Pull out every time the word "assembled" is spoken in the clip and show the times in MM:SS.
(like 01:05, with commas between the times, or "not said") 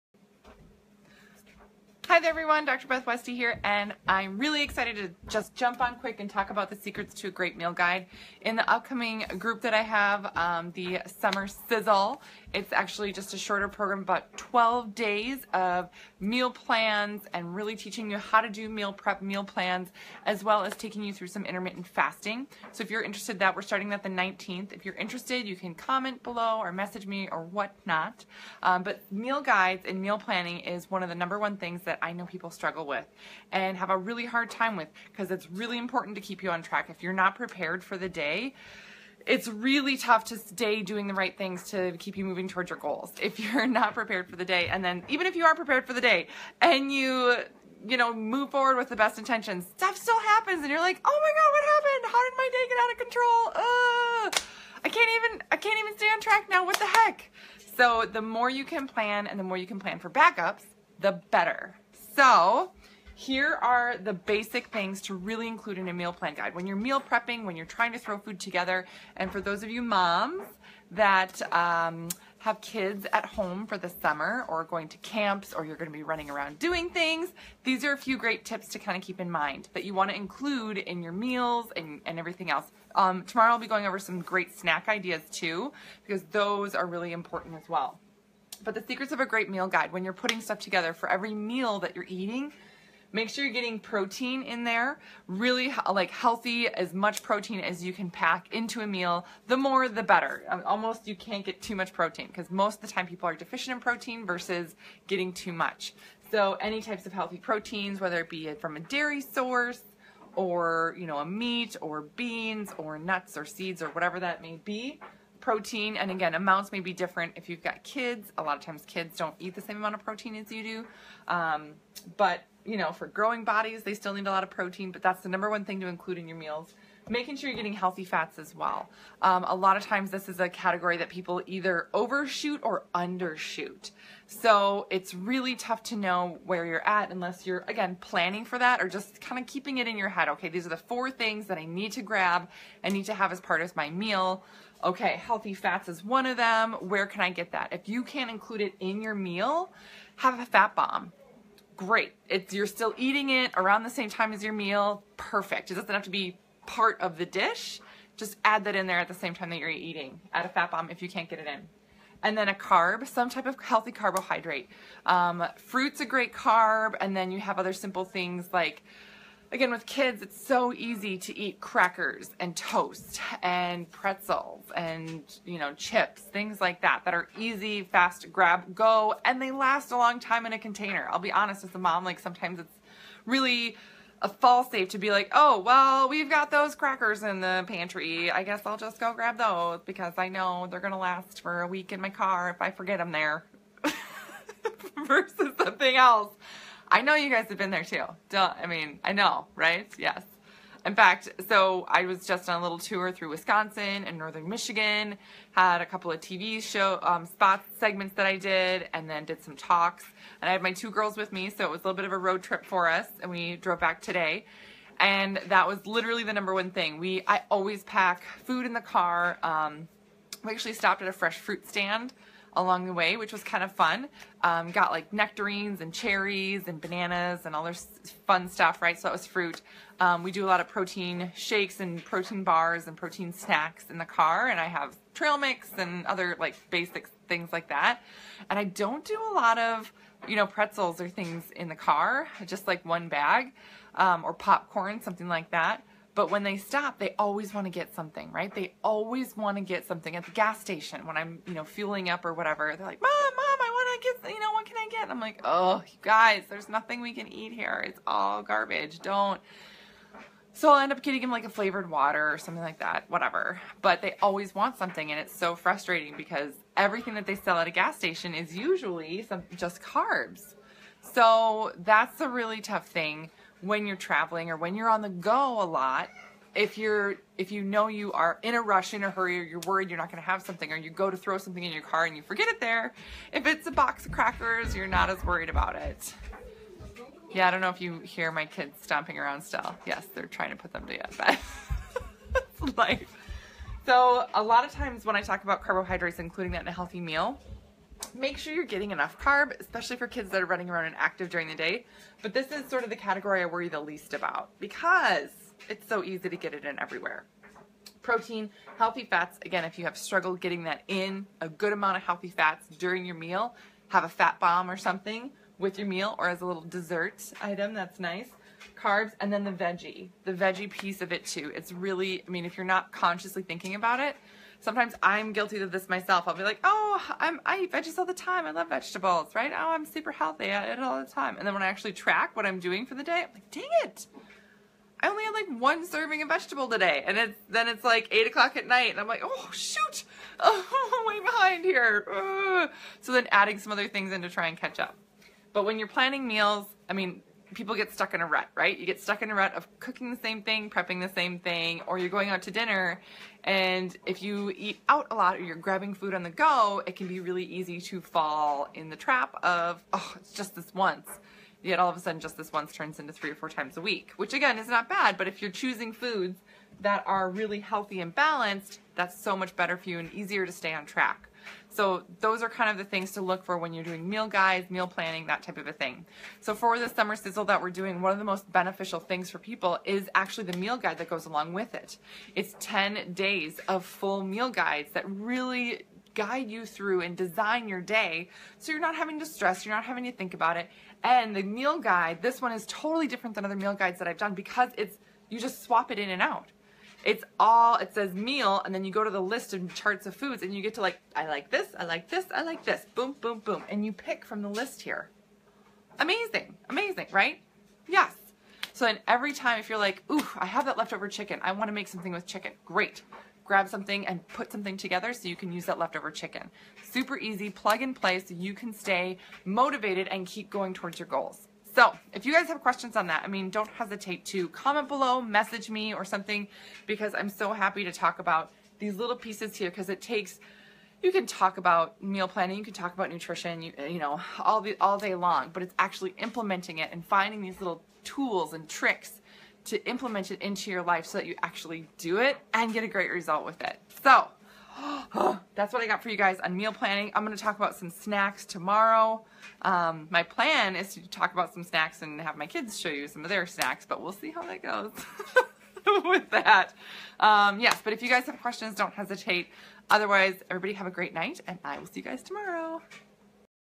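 not said.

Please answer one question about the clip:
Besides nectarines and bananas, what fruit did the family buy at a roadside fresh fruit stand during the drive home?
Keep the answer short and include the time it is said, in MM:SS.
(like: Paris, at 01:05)
cherries, at 03:45.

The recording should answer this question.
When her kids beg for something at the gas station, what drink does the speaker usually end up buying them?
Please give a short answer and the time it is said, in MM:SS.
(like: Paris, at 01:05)
flavored water, at 04:21.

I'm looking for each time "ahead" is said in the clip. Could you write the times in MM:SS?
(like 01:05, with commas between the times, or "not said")
not said.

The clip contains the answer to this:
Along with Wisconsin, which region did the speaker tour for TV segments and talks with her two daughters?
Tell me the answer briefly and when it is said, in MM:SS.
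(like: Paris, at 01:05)
northern Michigan, at 03:24.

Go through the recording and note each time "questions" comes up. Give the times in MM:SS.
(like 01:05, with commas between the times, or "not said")
07:02, 07:38.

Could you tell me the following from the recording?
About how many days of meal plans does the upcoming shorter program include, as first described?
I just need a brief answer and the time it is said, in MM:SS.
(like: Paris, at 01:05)
12, at 00:14.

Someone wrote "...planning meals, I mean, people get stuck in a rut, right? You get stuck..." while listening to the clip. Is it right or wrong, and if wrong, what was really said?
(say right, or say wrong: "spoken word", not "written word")
right.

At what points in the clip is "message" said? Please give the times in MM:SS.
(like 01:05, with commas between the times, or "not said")
00:26, 07:05.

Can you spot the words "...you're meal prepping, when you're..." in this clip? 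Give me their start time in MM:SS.
01:06.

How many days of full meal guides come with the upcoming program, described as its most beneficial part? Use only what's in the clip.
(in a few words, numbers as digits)
10.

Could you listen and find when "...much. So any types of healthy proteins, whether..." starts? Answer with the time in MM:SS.
01:45.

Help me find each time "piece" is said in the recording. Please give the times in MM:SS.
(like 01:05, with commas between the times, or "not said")
05:20, 07:09.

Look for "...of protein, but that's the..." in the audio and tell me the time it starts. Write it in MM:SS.
02:04.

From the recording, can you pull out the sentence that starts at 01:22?
Um, tomorrow I'll be going over some great snack ideas too because those are really important as well.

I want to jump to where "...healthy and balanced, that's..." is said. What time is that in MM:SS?
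06:07.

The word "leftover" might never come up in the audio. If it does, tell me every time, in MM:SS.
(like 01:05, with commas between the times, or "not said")
06:50, 06:55.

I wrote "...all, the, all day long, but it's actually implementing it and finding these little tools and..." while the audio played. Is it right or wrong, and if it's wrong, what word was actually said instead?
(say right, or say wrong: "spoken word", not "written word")
right.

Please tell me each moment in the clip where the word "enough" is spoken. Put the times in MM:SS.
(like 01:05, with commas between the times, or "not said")
04:58.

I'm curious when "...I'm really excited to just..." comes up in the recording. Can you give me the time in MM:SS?
00:04.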